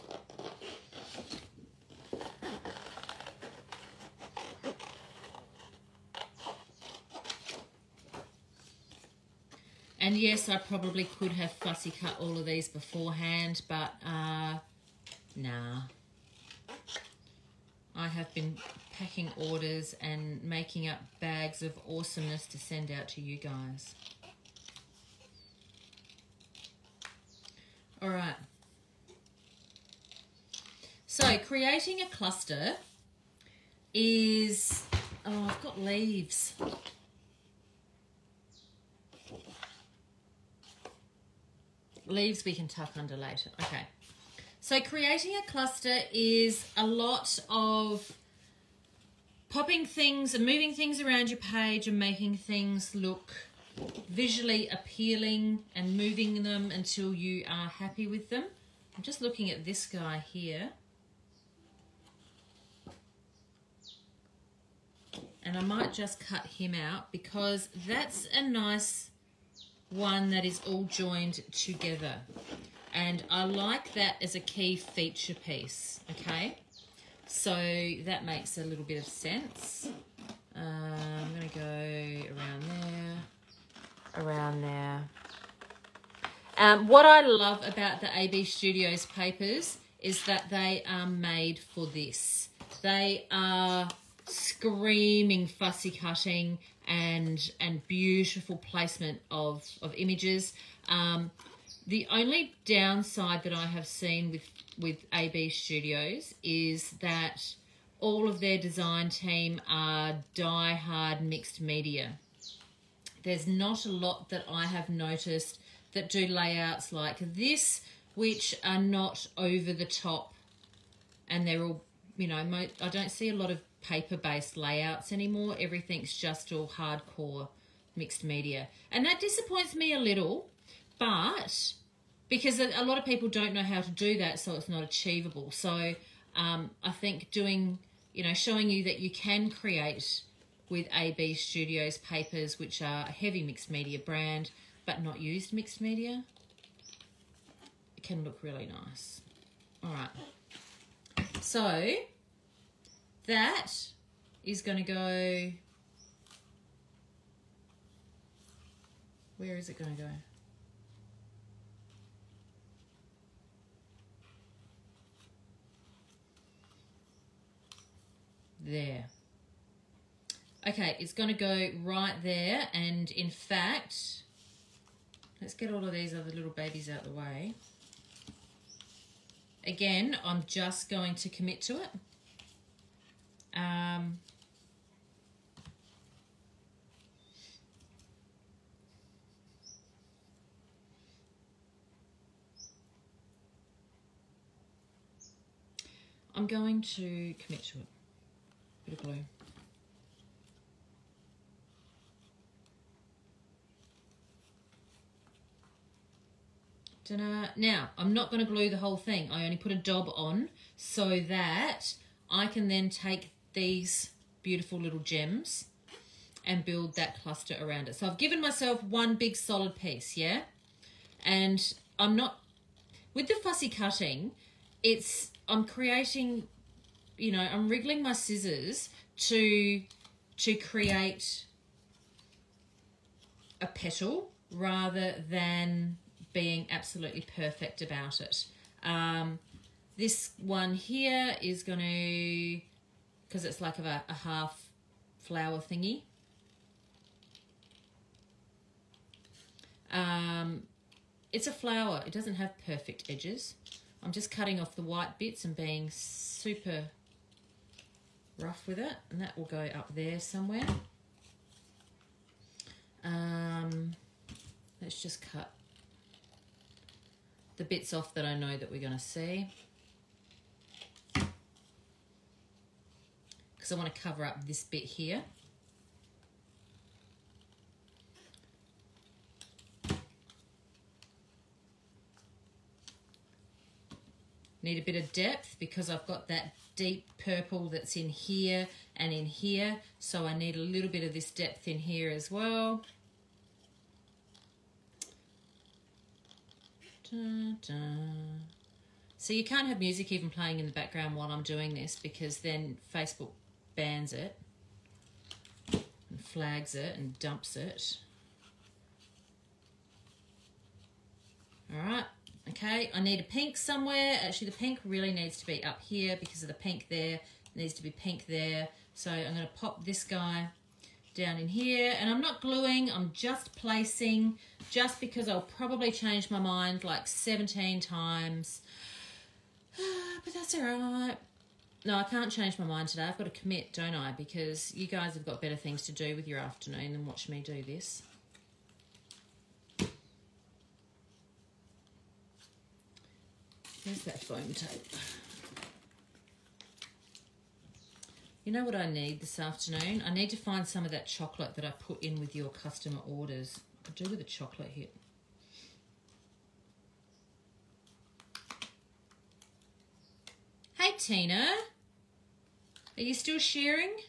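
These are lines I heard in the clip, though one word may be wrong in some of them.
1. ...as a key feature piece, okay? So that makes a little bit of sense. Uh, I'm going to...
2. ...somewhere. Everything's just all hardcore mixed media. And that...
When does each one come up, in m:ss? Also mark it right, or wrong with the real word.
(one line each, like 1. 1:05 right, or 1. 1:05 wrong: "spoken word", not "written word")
1. 1:14 right
2. 2:05 wrong: "anymore", not "somewhere".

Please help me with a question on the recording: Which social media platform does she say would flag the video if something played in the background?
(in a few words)
Facebook.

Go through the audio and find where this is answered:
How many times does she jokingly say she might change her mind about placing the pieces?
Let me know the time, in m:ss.
5:27.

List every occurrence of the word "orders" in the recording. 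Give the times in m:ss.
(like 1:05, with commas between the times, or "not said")
0:19, 5:53.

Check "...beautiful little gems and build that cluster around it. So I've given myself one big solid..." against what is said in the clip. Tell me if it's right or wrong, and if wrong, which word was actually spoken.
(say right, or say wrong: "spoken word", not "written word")
right.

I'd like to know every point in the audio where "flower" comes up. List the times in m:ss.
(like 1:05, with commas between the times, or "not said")
4:05, 4:11.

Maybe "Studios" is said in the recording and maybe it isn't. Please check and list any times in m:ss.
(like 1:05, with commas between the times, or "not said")
1:28, 1:45, 2:21.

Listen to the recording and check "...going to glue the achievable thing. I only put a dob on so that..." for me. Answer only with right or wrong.
wrong.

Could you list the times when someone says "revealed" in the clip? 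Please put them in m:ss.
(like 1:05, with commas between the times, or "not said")
not said.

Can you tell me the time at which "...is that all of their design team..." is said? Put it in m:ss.
1:46.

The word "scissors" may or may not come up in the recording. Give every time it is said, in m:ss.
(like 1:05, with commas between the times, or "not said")
3:48.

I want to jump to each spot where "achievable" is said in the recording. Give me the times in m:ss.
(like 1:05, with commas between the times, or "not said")
2:14.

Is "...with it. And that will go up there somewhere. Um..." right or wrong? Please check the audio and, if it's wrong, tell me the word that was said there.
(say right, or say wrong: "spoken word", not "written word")
right.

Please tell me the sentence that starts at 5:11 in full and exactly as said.
All right, okay, I need a pink somewhere.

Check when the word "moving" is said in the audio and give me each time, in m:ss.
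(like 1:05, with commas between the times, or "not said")
0:50, 0:55.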